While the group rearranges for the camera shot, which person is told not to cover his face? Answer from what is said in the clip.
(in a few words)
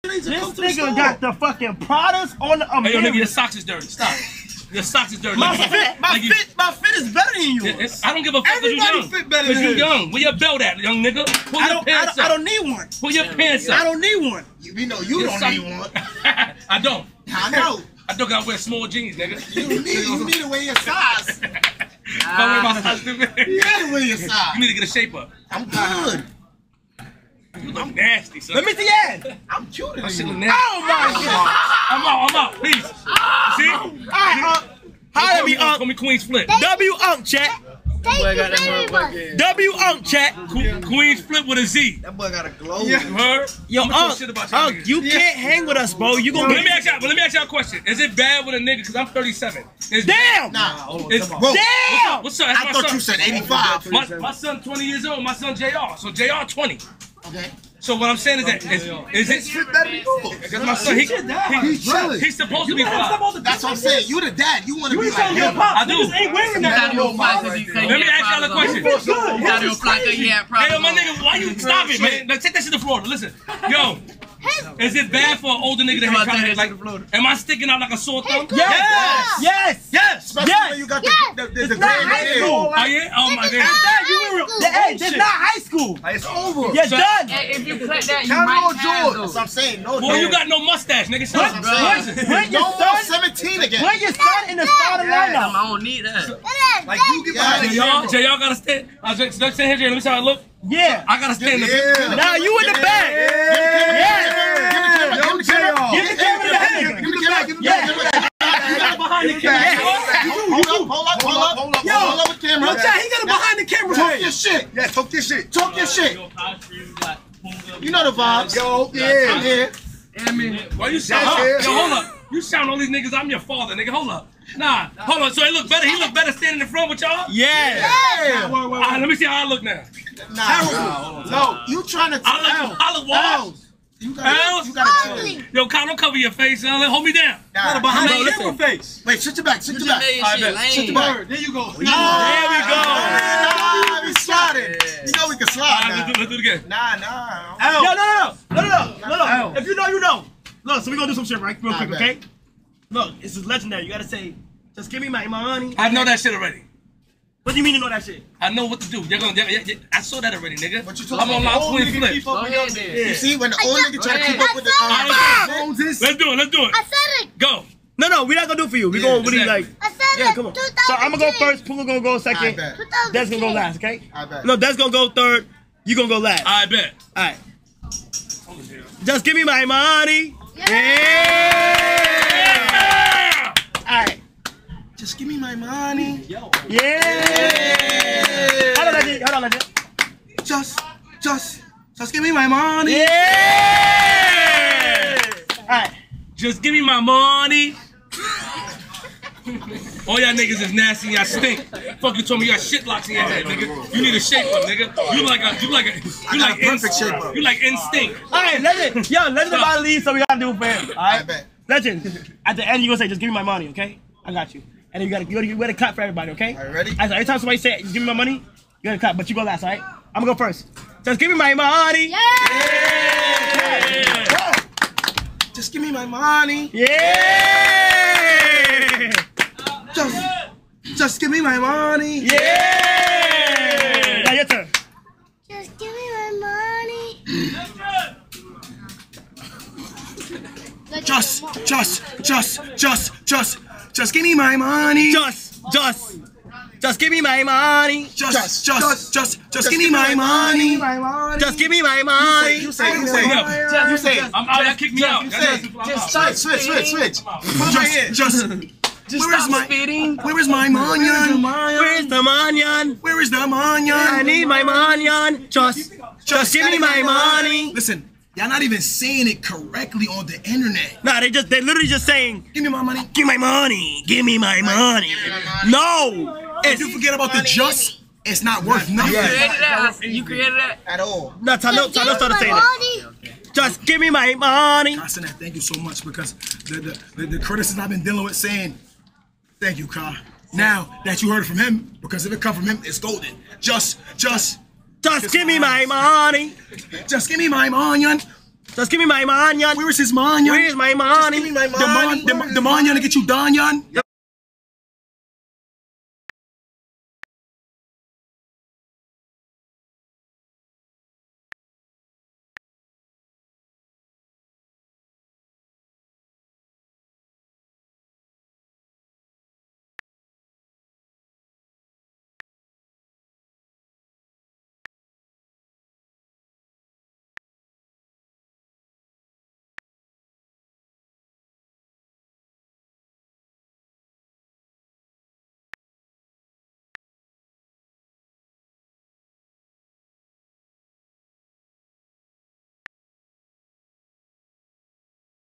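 Kyle.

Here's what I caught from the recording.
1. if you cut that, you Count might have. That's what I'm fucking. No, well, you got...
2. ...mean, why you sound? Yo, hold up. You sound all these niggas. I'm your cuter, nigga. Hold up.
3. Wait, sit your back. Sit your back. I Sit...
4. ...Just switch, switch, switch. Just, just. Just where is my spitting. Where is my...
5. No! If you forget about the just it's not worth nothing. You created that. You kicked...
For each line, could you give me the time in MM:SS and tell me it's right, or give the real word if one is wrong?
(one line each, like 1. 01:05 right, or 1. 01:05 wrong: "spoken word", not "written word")
1. 01:27 wrong: "saying", not "fucking"
2. 02:00 wrong: "father", not "cuter"
3. 02:19 right
4. 04:15 right
5. 04:35 wrong: "created", not "kicked".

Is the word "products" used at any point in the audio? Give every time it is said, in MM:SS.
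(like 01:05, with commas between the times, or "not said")
00:01.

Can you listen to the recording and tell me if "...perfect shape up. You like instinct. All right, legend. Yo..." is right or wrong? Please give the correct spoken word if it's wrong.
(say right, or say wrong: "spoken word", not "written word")
right.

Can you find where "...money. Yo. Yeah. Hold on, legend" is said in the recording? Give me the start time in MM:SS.
03:05.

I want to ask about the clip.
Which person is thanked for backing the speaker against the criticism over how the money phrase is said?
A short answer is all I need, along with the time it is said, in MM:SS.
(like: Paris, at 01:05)
Constantine, at 04:44.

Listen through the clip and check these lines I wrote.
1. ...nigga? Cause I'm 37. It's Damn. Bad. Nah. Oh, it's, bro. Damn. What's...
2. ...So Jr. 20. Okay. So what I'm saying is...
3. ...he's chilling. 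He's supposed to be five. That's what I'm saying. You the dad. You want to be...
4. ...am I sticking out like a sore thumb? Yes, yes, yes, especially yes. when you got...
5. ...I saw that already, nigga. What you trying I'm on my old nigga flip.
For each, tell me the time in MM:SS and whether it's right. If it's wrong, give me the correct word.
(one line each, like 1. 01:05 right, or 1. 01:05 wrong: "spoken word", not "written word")
1. 00:48 right
2. 00:55 right
3. 01:01 right
4. 01:17 right
5. 02:39 wrong: "talking", not "trying".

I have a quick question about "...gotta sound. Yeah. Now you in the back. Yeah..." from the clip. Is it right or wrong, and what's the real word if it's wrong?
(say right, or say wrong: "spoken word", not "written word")
wrong: "stand", not "sound".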